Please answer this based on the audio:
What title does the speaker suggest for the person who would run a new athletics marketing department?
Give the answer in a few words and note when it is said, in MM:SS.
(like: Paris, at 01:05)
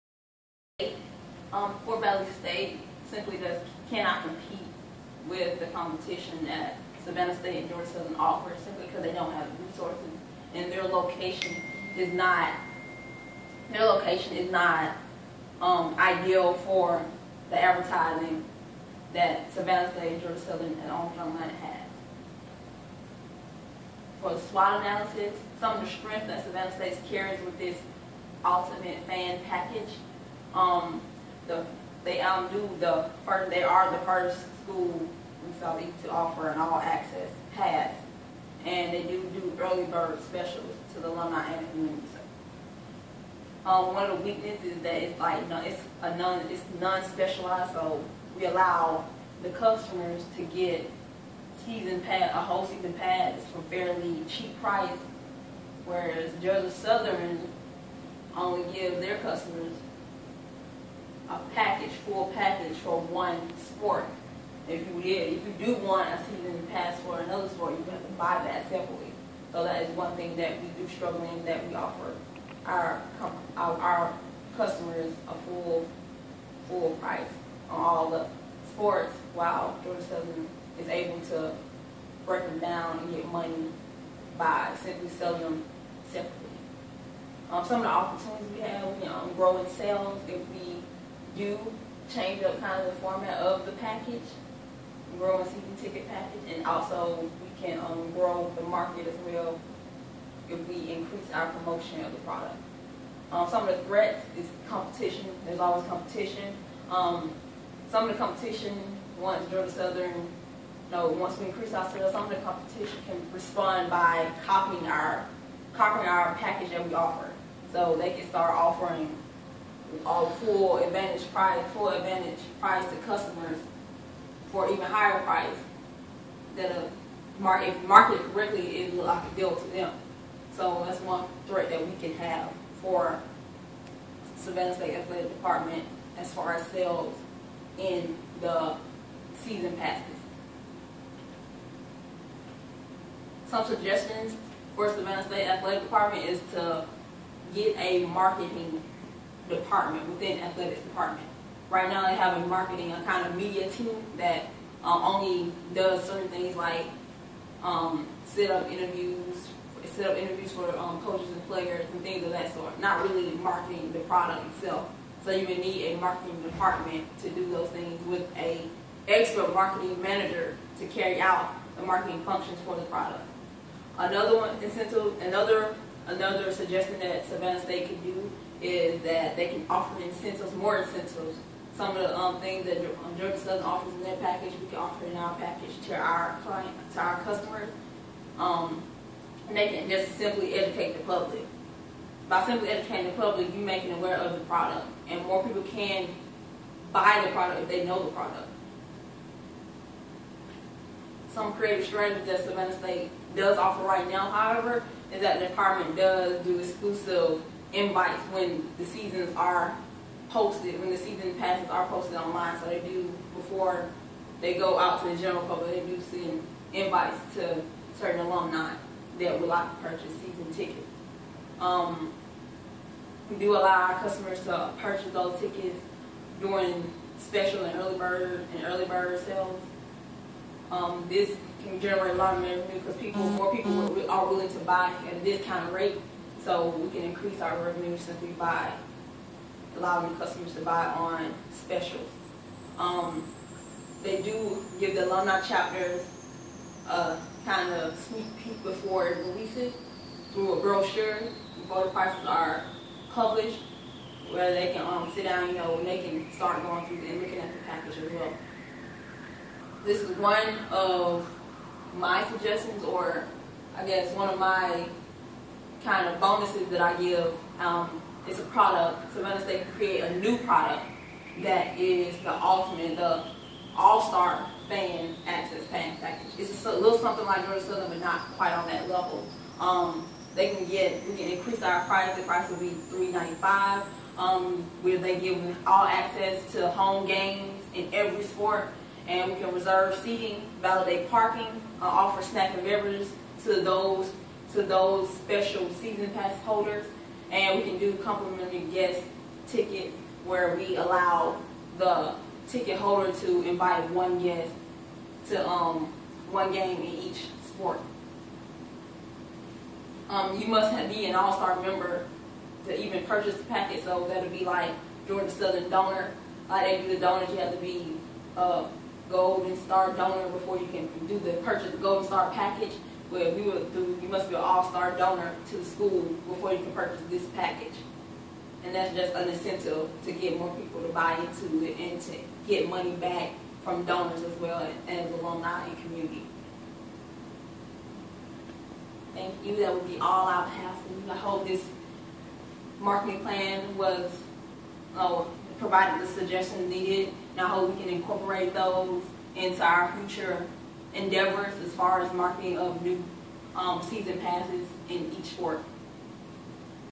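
marketing manager, at 02:49.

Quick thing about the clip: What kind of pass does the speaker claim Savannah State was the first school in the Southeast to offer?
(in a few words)
all-access pass.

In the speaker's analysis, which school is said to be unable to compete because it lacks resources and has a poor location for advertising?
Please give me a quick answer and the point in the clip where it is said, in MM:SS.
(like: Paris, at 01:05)
Fort Valley State, at 00:01.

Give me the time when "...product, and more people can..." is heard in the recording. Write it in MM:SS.
03:14.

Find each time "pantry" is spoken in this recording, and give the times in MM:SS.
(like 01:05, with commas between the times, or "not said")
not said.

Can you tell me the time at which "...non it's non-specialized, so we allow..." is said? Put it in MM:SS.
00:46.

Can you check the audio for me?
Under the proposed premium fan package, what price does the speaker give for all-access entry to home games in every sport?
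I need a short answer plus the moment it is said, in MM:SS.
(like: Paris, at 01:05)
$3.95, at 04:42.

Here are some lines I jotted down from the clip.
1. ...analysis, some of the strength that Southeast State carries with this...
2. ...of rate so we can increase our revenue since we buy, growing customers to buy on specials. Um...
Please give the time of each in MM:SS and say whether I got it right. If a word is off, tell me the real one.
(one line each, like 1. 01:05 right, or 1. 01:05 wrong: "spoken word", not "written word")
1. 00:24 wrong: "Savannah", not "Southeast"
2. 03:55 wrong: "allowing", not "growing".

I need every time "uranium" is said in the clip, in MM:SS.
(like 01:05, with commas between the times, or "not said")
not said.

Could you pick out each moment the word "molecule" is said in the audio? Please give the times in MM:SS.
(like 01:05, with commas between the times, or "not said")
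not said.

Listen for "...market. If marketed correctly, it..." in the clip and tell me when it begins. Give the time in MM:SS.
02:07.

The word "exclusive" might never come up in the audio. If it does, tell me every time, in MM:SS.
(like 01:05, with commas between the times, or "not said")
03:26.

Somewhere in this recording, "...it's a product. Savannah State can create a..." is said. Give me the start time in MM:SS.
04:28.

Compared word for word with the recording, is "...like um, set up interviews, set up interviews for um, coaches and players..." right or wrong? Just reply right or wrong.
right.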